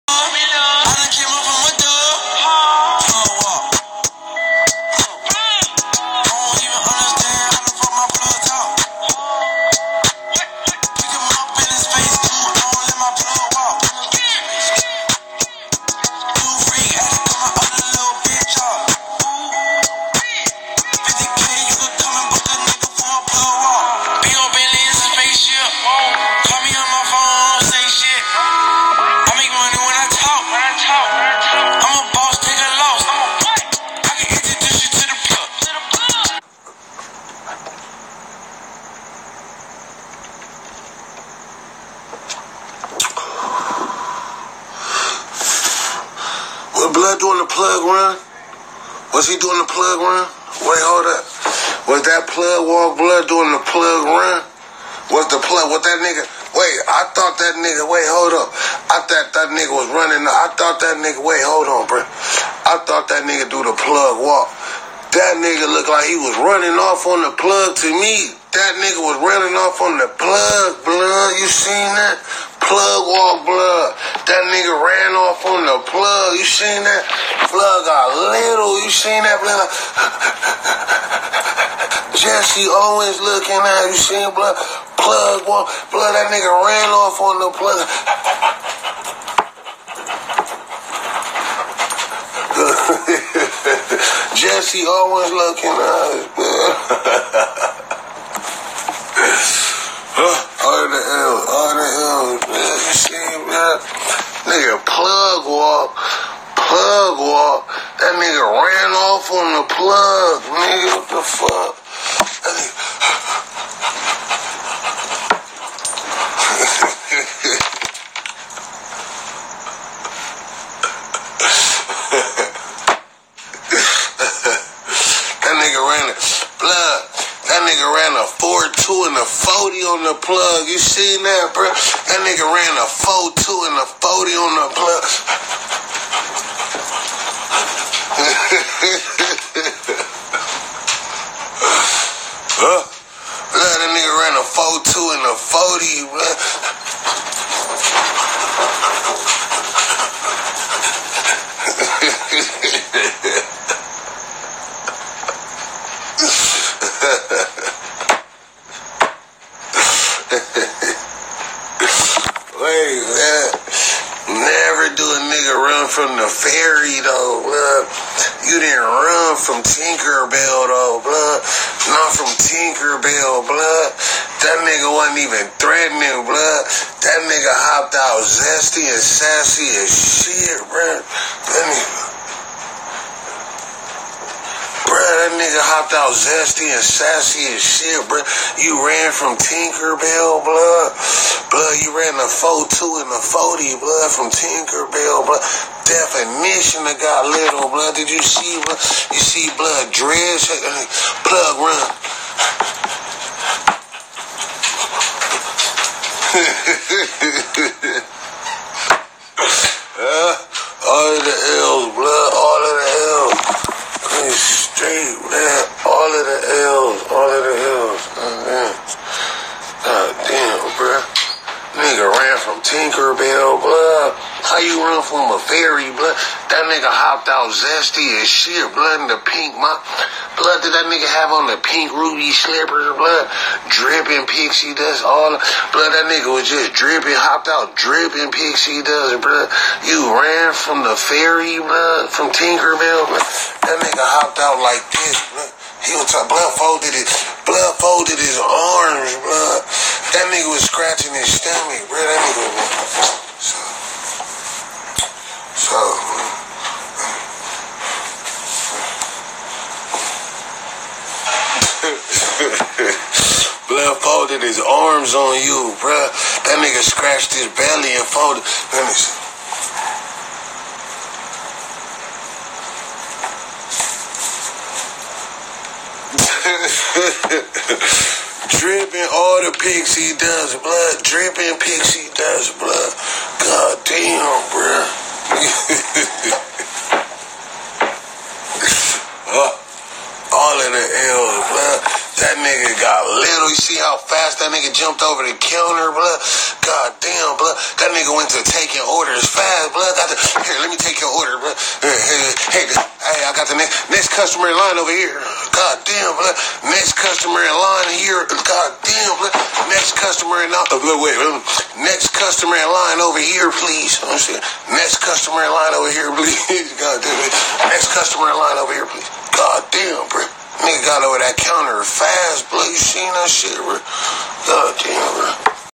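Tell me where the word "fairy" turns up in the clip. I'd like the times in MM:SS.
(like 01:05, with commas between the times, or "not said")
02:46, 03:45, 04:00.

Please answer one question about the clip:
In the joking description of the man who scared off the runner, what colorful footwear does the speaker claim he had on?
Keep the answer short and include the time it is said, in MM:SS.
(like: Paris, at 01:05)
pink ruby slippers, at 03:51.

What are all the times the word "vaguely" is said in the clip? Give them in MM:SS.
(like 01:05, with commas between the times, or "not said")
not said.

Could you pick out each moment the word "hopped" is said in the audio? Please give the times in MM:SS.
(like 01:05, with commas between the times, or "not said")
02:57, 03:05, 03:46, 03:57, 04:04.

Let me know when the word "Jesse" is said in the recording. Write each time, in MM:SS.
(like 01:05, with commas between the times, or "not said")
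01:22, 01:34.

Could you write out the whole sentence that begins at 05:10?
Uh, wait, next customer in line over here, please.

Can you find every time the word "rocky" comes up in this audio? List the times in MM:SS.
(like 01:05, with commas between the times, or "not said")
not said.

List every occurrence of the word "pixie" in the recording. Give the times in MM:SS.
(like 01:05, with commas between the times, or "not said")
03:54, 03:58.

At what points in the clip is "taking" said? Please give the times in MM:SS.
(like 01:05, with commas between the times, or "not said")
04:58.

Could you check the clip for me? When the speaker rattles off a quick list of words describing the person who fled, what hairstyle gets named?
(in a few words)
dreads.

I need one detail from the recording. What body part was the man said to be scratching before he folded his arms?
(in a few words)
stomach.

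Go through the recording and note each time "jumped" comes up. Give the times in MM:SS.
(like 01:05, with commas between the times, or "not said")
04:54.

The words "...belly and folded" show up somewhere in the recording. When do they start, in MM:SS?
04:27.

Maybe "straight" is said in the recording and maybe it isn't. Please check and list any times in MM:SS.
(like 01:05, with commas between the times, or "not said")
03:34.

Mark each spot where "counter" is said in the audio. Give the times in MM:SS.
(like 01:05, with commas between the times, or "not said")
04:55, 05:21.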